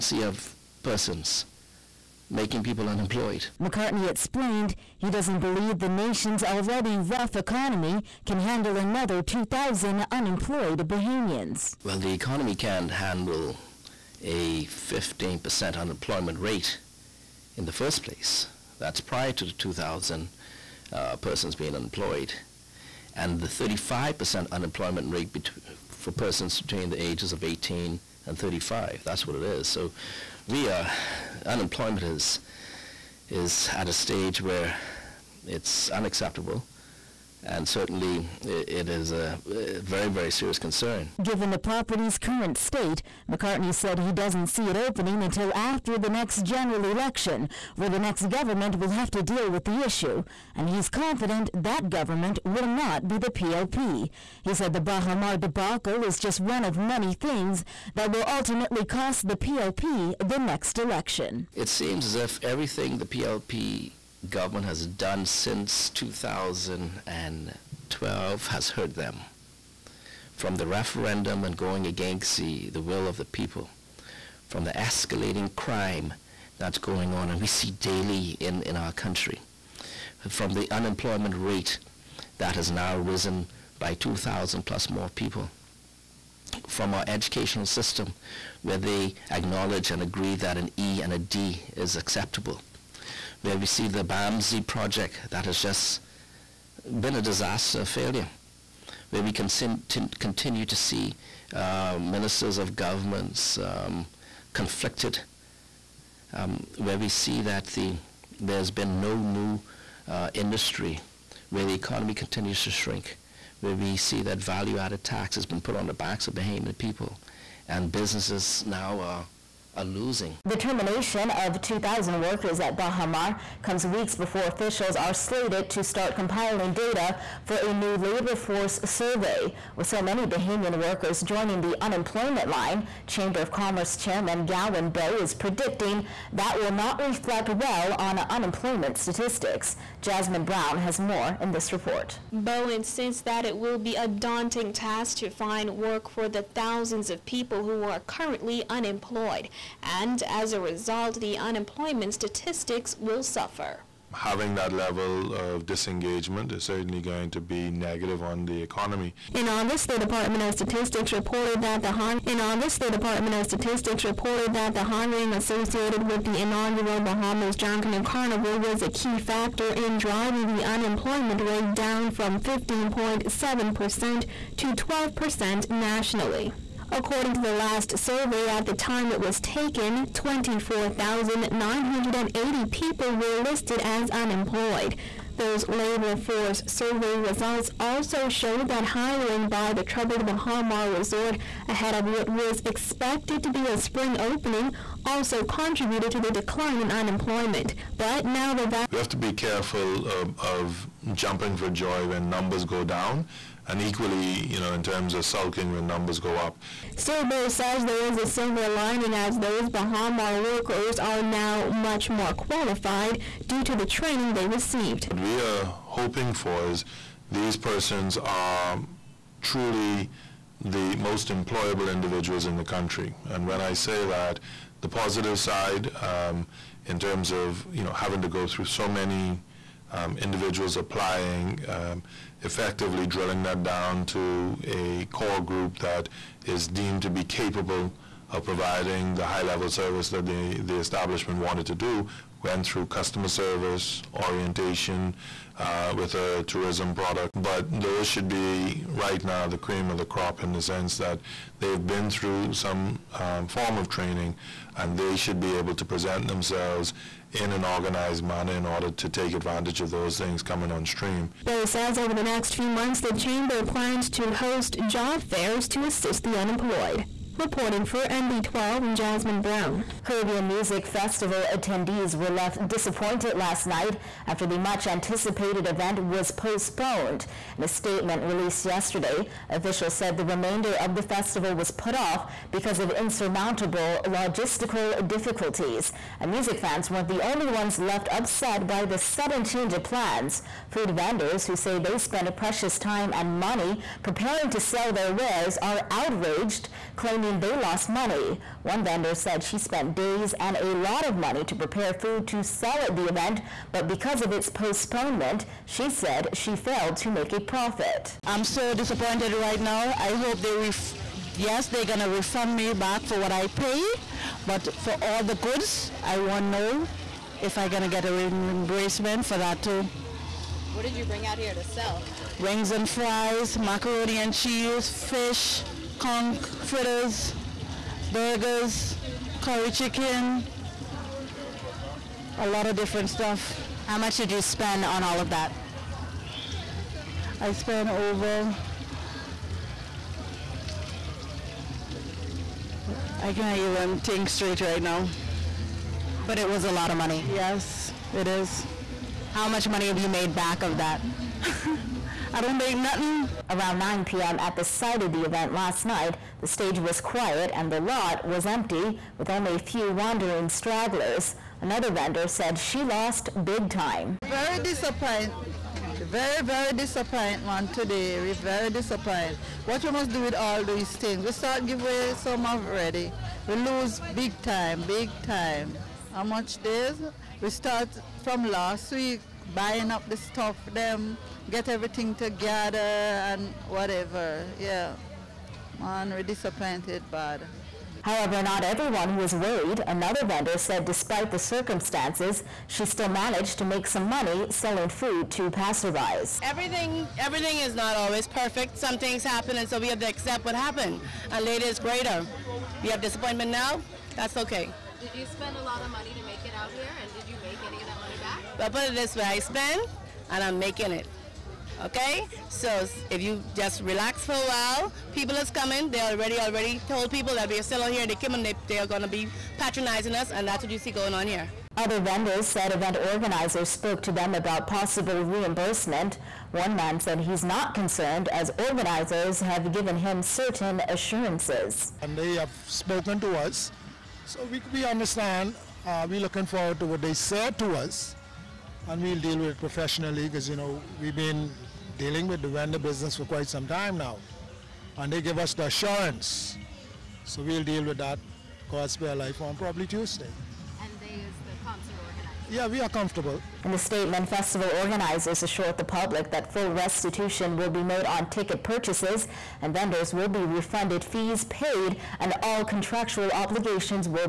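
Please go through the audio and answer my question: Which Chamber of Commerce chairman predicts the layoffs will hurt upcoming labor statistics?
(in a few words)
Gowon Bowe.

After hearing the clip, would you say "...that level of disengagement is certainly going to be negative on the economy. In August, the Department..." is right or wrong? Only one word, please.
right.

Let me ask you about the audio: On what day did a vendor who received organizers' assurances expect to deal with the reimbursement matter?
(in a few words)
Tuesday.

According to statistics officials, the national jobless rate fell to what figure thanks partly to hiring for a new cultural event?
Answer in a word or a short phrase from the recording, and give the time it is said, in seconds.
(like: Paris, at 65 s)
12%, at 174 s.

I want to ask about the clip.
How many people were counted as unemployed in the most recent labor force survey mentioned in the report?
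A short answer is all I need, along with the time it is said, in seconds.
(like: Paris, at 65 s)
24,980, at 180 s.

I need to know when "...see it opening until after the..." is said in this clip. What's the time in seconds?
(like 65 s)
44 s.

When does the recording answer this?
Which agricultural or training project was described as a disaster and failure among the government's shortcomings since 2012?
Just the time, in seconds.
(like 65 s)
94 s.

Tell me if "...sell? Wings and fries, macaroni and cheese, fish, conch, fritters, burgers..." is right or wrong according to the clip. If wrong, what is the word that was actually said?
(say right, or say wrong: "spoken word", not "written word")
right.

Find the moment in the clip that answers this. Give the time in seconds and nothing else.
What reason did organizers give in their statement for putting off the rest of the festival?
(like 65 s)
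282 s.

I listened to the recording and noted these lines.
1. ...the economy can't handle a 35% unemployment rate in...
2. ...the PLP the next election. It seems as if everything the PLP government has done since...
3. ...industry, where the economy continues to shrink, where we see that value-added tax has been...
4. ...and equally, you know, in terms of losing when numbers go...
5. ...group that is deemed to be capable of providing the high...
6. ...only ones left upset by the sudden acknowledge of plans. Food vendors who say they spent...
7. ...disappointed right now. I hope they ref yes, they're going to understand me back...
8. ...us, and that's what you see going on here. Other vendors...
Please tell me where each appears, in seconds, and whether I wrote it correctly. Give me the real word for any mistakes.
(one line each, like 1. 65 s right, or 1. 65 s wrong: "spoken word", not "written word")
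1. 11 s wrong: "15", not "35"
2. 59 s right
3. 110 s right
4. 203 s wrong: "sulking", not "losing"
5. 235 s right
6. 287 s wrong: "change", not "acknowledge"
7. 308 s wrong: "refund", not "understand"
8. 420 s right.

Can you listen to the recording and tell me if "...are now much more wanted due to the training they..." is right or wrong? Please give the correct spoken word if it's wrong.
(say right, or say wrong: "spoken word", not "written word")
wrong: "qualified", not "wanted".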